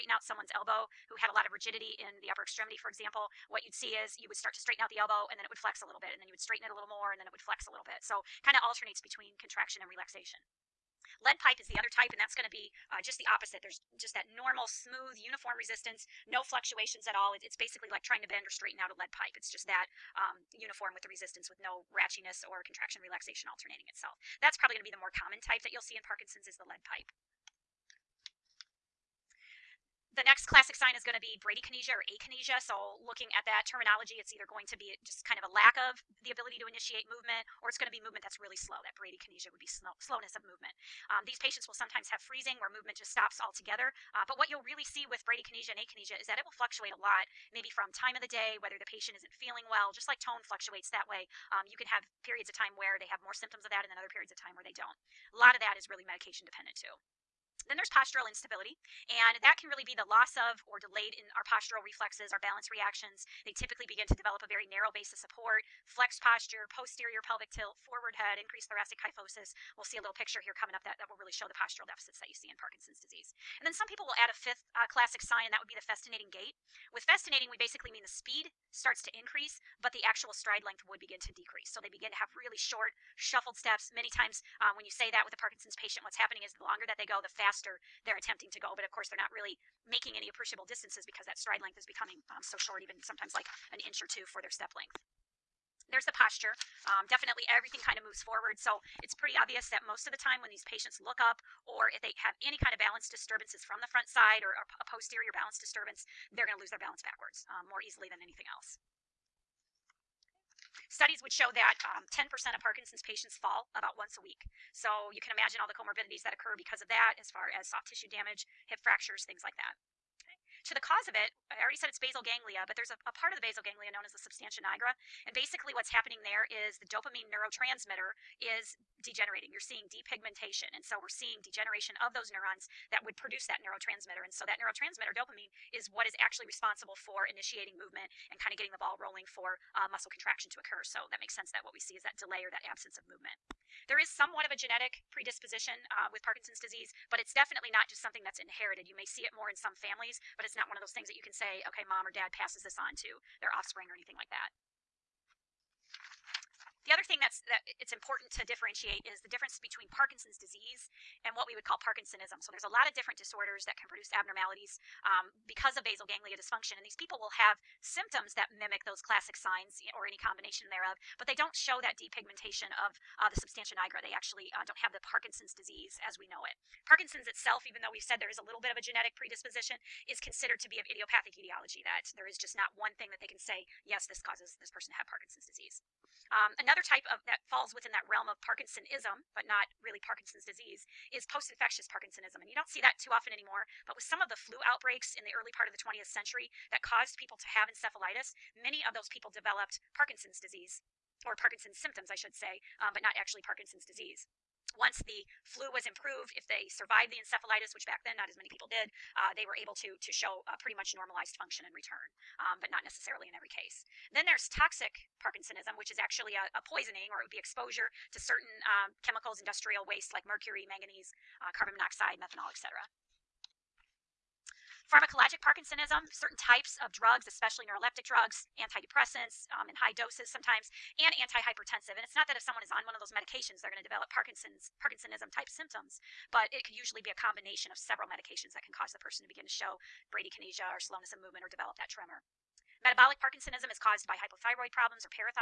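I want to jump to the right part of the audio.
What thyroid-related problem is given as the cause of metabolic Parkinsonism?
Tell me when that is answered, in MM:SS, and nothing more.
04:04.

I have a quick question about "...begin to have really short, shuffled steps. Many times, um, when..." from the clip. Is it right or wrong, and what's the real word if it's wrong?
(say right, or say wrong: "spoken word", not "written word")
right.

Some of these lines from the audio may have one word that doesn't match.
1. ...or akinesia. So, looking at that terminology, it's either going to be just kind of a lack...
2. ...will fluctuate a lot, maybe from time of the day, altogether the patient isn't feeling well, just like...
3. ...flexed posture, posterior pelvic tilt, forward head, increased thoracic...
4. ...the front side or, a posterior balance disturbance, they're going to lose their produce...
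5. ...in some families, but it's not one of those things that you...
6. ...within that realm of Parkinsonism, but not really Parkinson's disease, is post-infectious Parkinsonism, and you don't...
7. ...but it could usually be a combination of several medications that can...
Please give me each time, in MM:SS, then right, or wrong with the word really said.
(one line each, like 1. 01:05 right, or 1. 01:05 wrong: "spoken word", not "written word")
1. 00:31 right
2. 00:46 wrong: "whether", not "altogether"
3. 01:05 right
4. 01:43 wrong: "balance", not "produce"
5. 02:29 right
6. 03:07 right
7. 03:56 right.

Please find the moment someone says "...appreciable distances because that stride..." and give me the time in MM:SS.
01:30.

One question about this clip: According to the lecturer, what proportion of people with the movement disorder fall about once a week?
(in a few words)
10%.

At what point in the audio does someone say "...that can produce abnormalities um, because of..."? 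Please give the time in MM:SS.
02:43.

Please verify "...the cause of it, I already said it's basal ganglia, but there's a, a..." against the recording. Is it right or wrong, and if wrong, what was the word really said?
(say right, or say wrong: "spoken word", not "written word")
right.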